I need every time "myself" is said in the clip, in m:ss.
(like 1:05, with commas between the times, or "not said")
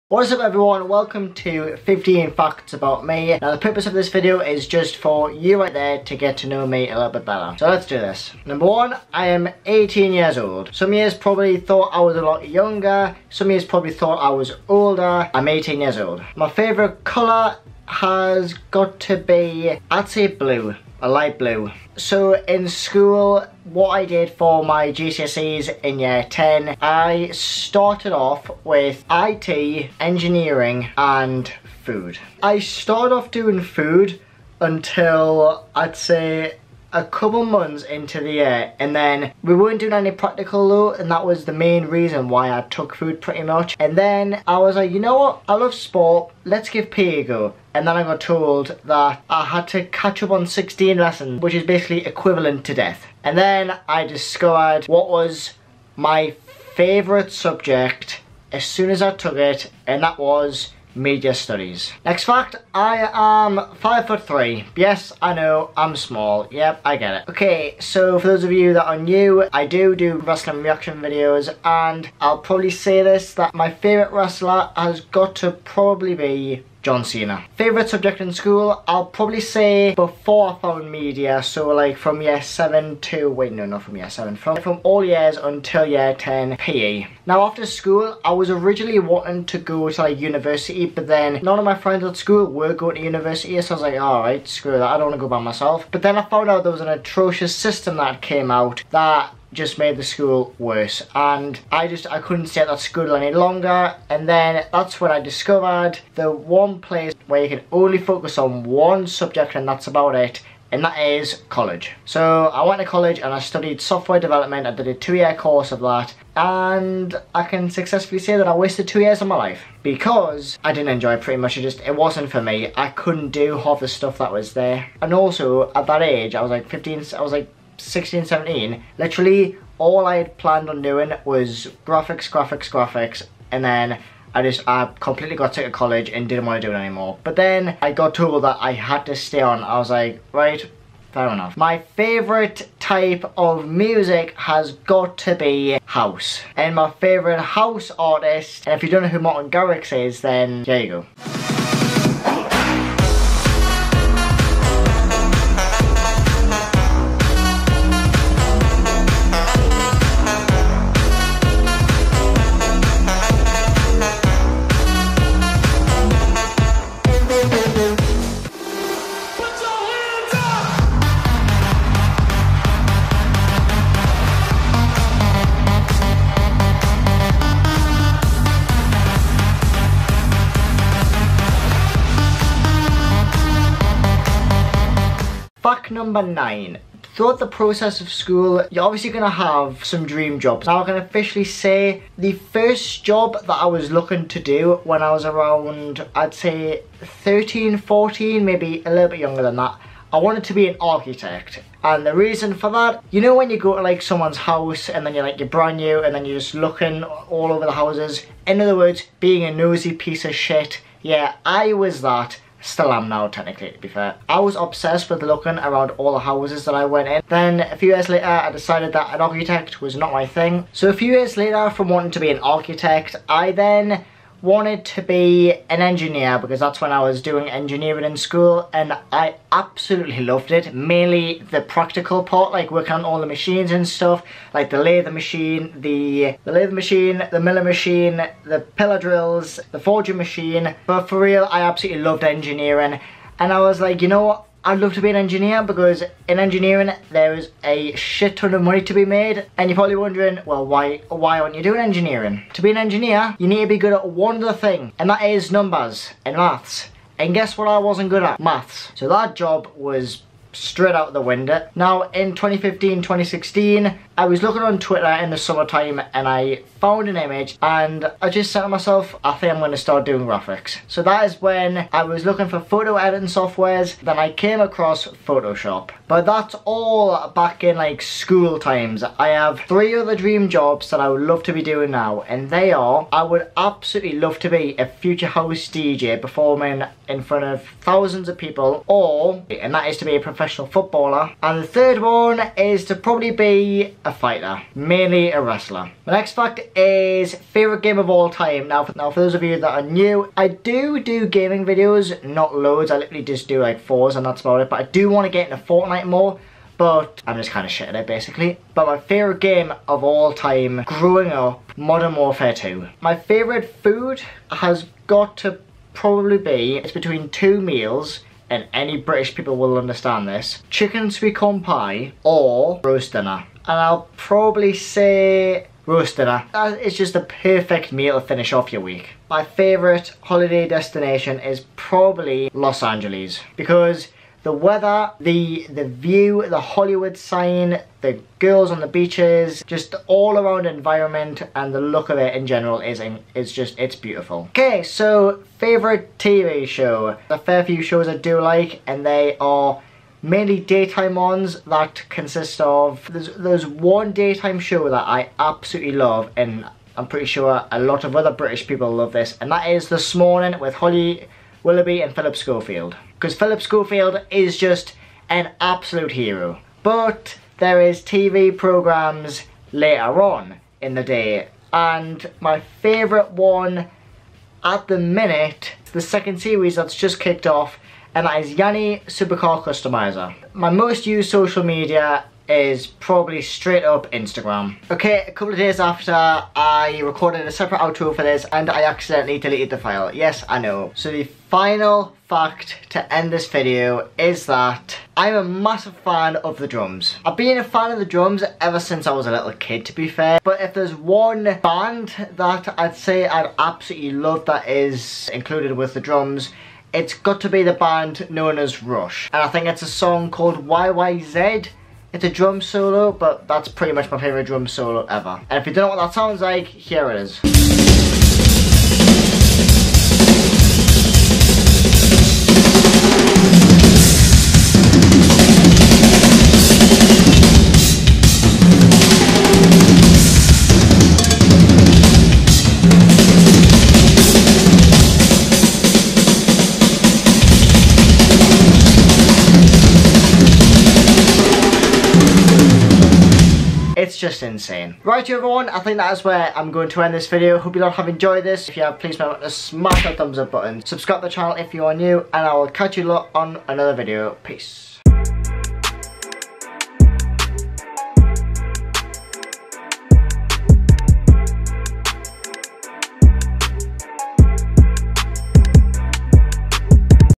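1:35, 4:28.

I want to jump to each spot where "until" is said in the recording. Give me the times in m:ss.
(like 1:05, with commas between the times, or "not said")
0:34, 1:25.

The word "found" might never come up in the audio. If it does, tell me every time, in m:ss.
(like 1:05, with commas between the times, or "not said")
1:20, 1:36, 4:26.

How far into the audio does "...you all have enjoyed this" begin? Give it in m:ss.
7:27.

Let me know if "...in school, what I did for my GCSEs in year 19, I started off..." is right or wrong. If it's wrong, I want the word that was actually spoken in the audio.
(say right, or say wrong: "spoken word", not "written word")
wrong: "10", not "19".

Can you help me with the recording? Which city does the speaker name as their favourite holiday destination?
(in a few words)
Los Angeles.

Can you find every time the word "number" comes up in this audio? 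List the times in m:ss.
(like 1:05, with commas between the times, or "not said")
0:08, 3:05, 4:15.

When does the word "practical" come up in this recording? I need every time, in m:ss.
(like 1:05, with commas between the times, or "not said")
0:40, 3:51.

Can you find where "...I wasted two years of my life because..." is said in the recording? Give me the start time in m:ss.
1:58.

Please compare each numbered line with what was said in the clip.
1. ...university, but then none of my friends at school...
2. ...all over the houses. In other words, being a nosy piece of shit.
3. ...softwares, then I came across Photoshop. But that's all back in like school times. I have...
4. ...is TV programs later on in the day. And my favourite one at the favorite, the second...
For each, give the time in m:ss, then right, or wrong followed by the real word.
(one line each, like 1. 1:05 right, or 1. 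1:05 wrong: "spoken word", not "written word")
1. 1:30 right
2. 3:27 right
3. 4:33 right
4. 6:07 wrong: "minute", not "favorite".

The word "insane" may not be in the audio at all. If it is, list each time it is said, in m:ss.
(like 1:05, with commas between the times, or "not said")
7:24.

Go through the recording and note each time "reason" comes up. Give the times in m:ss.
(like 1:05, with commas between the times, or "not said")
0:41, 3:22.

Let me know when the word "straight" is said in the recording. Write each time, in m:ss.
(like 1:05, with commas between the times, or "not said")
4:20, 6:23.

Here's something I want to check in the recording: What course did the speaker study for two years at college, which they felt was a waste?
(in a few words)
Software development.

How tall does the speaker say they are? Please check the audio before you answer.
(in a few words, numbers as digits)
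5 foot 3.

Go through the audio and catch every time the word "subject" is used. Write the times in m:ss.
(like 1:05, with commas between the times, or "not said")
0:57, 1:17, 1:49.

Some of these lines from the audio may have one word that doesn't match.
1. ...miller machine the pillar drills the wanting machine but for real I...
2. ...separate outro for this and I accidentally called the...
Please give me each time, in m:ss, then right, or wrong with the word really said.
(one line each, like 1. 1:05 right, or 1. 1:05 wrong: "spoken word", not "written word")
1. 3:57 wrong: "forging", not "wanting"
2. 6:27 wrong: "deleted", not "called".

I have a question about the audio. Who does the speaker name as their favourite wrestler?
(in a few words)
John Cena.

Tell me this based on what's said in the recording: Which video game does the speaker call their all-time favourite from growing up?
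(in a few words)
Modern Warfare 2.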